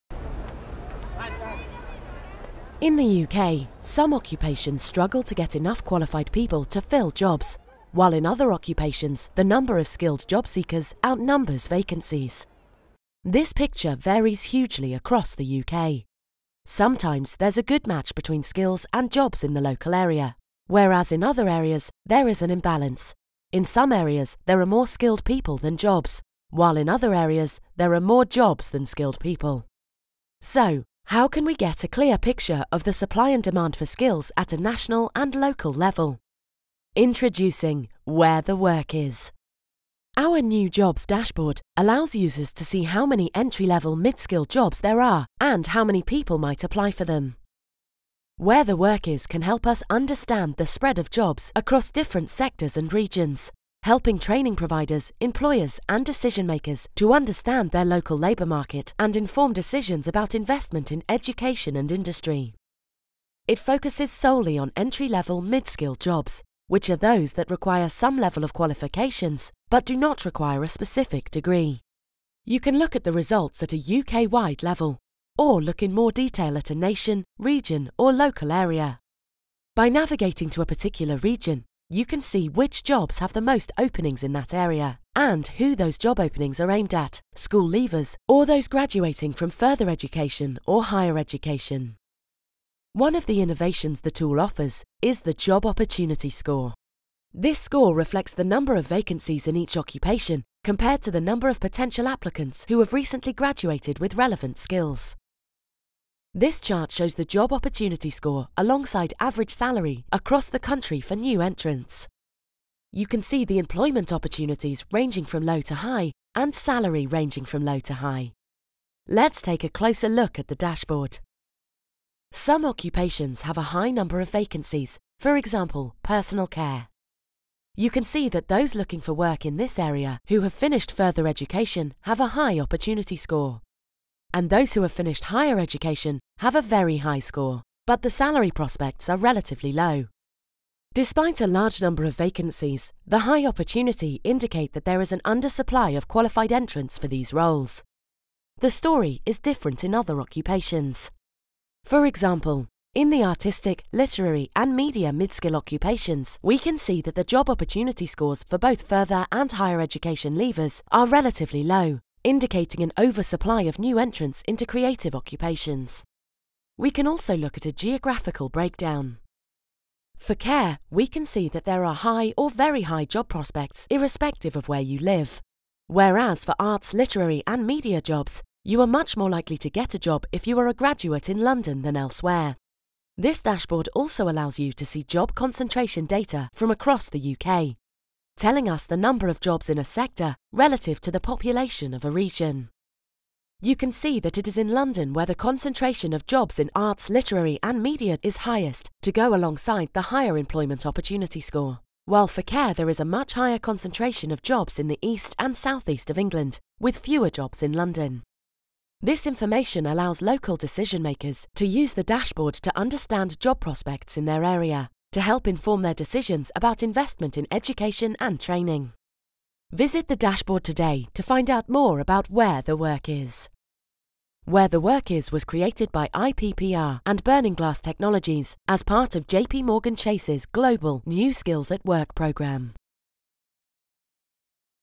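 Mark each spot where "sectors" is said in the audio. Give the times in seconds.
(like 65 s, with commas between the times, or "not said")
52 s, 189 s.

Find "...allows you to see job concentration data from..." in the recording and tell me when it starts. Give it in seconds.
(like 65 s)
184 s.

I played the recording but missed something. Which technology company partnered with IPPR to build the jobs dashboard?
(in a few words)
Burning Glass Technologies.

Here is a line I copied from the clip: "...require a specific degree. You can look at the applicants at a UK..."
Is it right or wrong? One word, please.
wrong.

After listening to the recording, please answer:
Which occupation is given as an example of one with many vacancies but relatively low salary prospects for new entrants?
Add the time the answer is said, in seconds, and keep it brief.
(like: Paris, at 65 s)
Personal care, at 126 s.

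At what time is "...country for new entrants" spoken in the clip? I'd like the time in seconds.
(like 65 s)
110 s.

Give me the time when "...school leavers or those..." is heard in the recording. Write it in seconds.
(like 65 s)
87 s.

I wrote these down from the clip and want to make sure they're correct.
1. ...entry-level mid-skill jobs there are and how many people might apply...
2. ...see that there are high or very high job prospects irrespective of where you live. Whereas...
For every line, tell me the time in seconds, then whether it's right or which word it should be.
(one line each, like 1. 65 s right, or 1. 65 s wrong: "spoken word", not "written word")
1. 43 s right
2. 171 s right.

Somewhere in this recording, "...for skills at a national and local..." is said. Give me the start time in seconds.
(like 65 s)
33 s.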